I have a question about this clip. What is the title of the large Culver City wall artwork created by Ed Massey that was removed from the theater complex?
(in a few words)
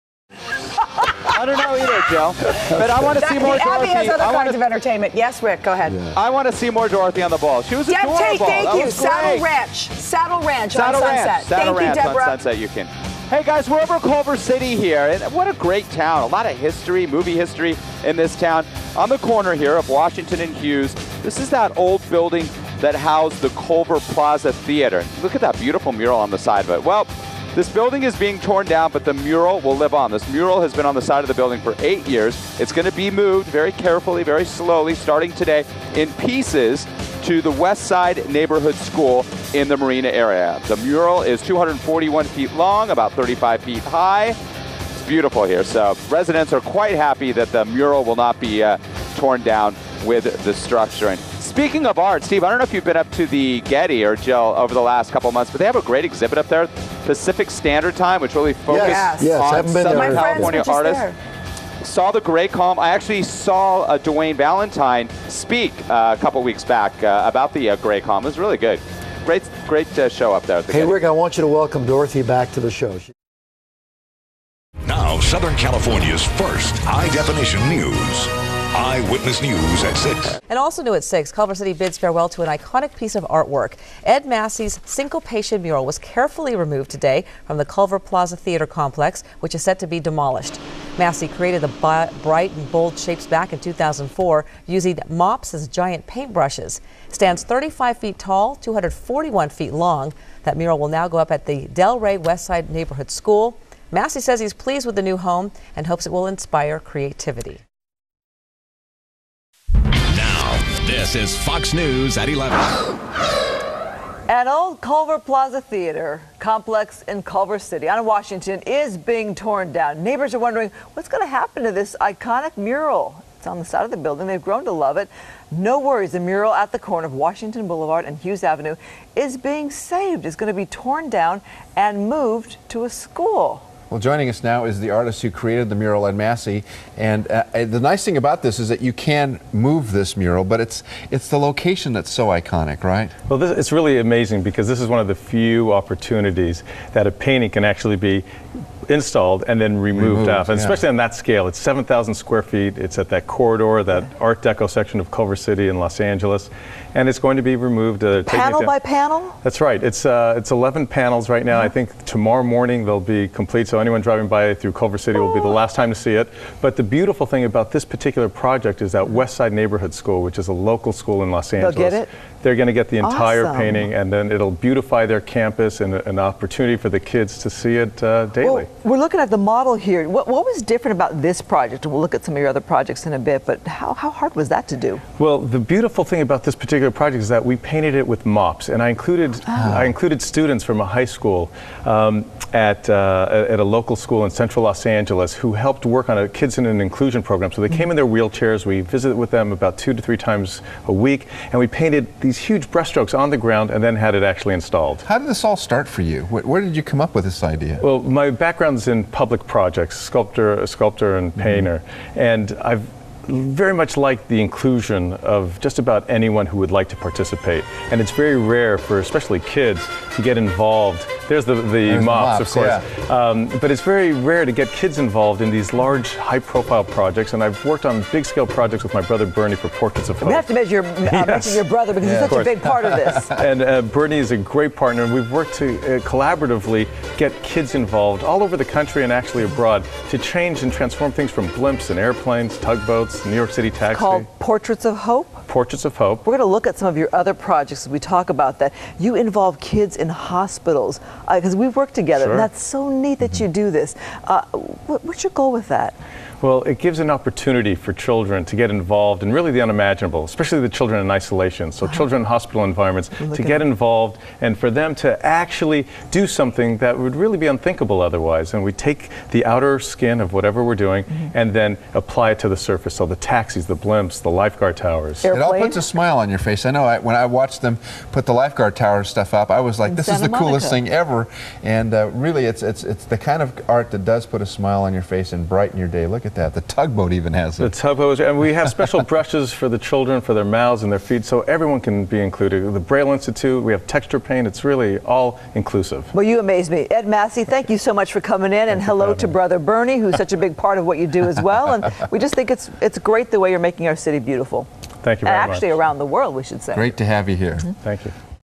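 Syncopation.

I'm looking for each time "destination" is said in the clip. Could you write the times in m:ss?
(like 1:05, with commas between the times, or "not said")
not said.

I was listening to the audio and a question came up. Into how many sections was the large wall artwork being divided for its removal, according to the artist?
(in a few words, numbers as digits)
11.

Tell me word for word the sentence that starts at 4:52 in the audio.
The Braille Institute, we have texture paint.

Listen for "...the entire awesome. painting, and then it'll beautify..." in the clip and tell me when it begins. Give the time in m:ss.
2:52.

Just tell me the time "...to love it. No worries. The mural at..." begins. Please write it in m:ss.
2:04.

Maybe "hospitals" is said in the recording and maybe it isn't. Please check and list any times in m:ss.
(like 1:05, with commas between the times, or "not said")
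4:10, 4:22.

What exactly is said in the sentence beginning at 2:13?
Well, joining us now is the artist who created the mural Ed Massey.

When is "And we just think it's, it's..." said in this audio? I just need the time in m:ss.
5:01.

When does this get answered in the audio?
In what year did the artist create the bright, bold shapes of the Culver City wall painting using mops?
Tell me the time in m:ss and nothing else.
1:33.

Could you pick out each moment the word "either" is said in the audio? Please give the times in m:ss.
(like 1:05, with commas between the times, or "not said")
0:01.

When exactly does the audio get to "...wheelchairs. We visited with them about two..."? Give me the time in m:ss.
3:18.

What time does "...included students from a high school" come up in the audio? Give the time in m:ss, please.
3:09.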